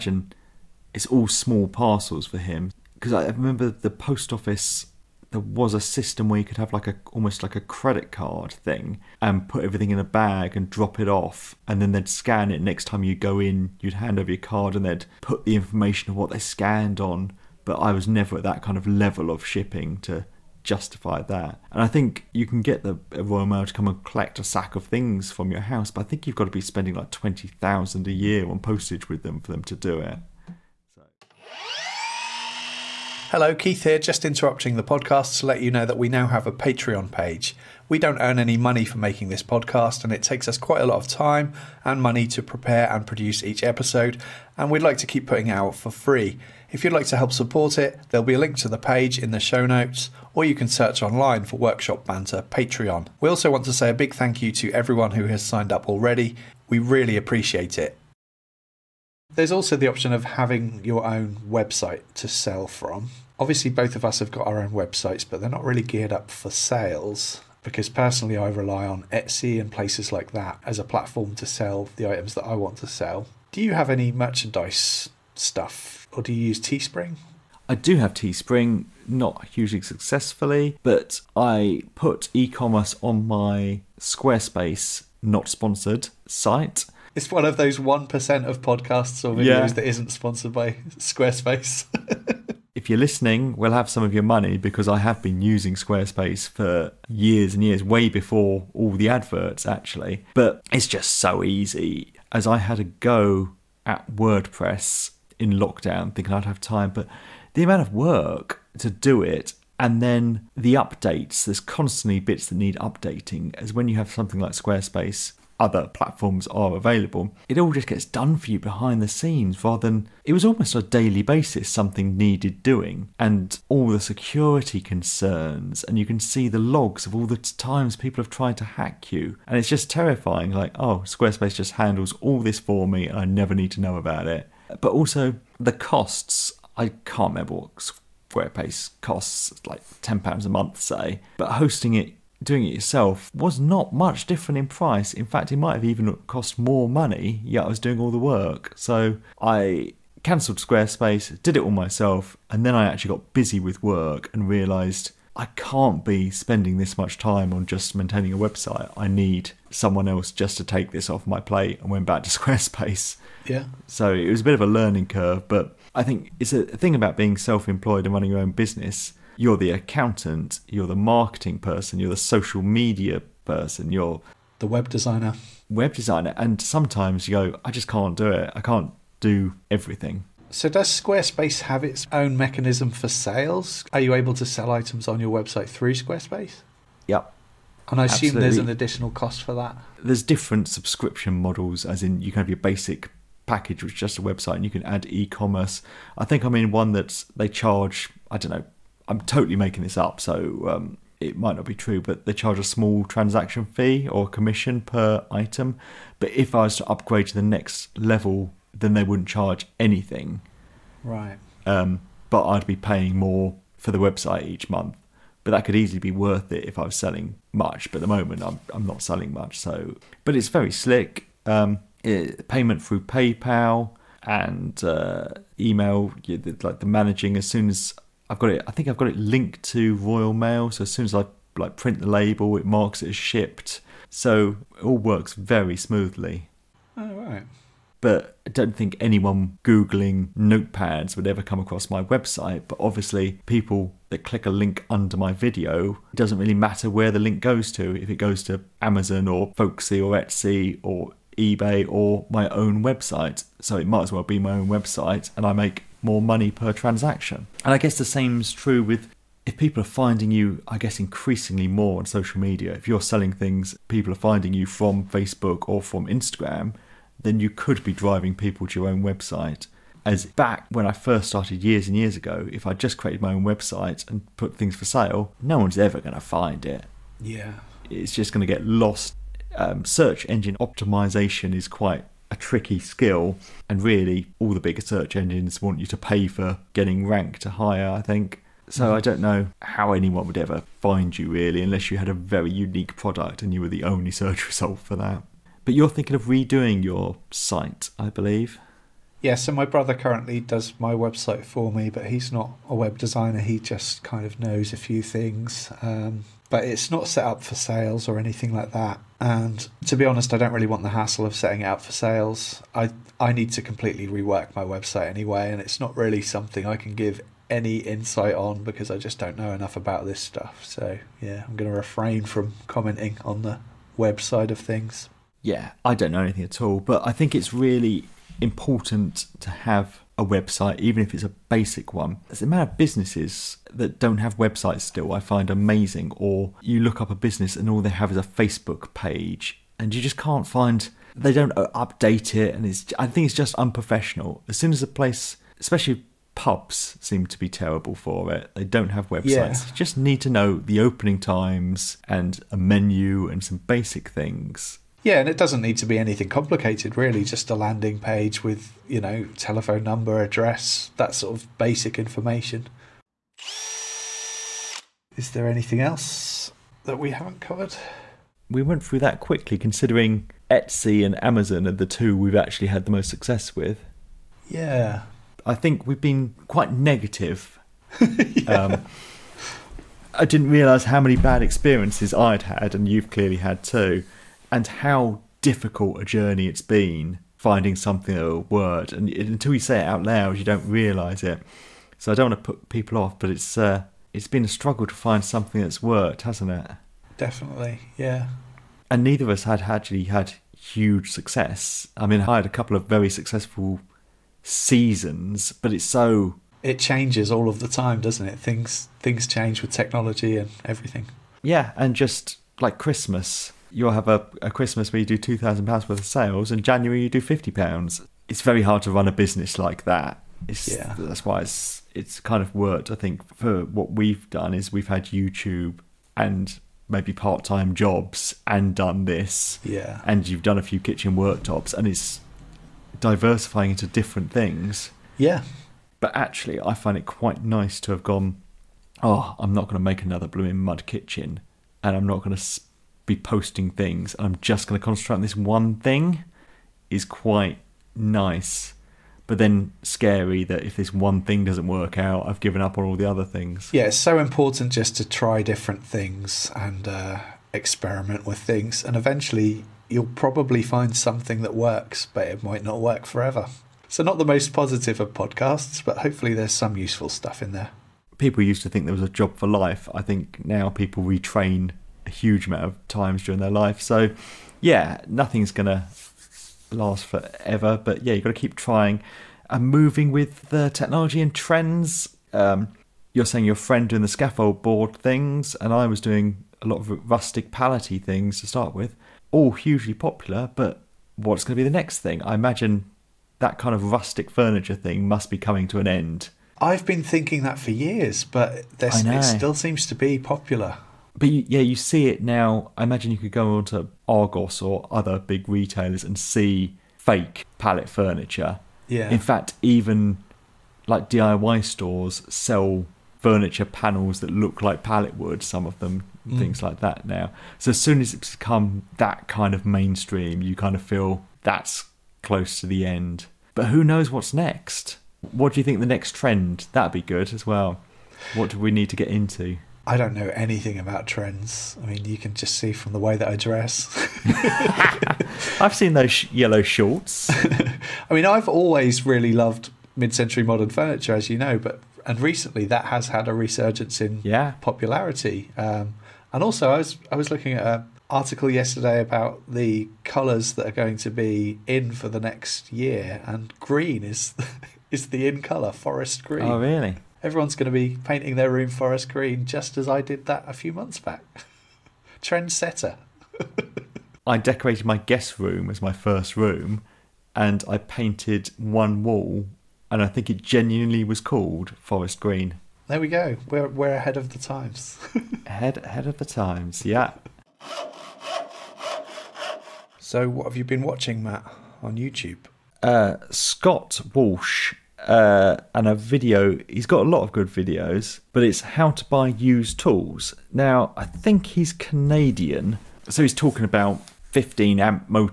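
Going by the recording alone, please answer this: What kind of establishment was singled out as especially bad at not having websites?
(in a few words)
Pubs.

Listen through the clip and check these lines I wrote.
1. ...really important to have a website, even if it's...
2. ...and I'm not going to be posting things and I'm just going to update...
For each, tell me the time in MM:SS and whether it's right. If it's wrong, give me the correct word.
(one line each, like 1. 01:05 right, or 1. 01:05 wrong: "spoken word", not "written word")
1. 05:27 right
2. 07:21 wrong: "concentrate", not "update".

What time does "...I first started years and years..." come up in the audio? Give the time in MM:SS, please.
04:30.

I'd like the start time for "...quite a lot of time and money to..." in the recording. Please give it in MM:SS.
00:40.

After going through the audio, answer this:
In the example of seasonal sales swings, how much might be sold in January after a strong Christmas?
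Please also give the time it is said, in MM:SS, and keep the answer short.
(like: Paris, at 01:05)
50 pounds, at 06:57.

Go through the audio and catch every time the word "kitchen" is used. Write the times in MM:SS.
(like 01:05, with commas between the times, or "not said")
07:10, 07:20.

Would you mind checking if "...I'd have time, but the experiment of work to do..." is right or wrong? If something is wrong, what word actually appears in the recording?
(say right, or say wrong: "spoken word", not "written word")
wrong: "amount", not "experiment".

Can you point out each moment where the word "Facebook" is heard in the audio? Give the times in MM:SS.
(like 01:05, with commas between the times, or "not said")
04:25, 05:38.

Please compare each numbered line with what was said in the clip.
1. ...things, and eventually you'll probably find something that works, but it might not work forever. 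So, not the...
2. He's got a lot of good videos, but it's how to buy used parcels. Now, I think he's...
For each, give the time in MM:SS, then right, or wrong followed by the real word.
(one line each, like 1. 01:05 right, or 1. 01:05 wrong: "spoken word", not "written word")
1. 07:38 right
2. 09:46 wrong: "tools", not "parcels".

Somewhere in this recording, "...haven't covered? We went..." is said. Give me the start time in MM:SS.
06:07.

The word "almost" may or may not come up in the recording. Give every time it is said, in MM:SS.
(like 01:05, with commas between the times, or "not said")
00:07, 02:00.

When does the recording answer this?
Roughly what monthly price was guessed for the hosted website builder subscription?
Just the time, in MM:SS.
02:20.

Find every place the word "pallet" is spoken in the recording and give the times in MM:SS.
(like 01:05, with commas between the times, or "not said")
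08:27, 08:34.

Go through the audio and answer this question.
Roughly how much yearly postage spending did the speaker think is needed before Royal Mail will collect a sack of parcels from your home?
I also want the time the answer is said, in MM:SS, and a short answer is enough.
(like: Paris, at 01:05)
20000, at 00:27.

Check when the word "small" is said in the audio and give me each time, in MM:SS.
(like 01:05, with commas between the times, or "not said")
00:01, 03:22.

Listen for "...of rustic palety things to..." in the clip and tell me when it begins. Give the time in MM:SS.
08:06.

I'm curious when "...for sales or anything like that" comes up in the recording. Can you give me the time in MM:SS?
05:07.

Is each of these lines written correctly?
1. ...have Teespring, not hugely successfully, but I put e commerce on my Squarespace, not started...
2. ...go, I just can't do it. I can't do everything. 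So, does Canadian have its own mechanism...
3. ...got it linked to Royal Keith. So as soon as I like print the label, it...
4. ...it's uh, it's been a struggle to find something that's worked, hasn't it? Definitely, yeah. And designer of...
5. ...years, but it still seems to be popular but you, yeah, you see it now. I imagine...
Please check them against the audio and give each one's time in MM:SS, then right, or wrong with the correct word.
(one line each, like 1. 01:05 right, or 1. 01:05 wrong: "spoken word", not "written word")
1. 01:17 wrong: "sponsored", not "started"
2. 02:57 wrong: "Squarespace", not "Canadian"
3. 03:48 wrong: "Mail", not "Keith"
4. 06:33 wrong: "neither", not "designer"
5. 08:17 right.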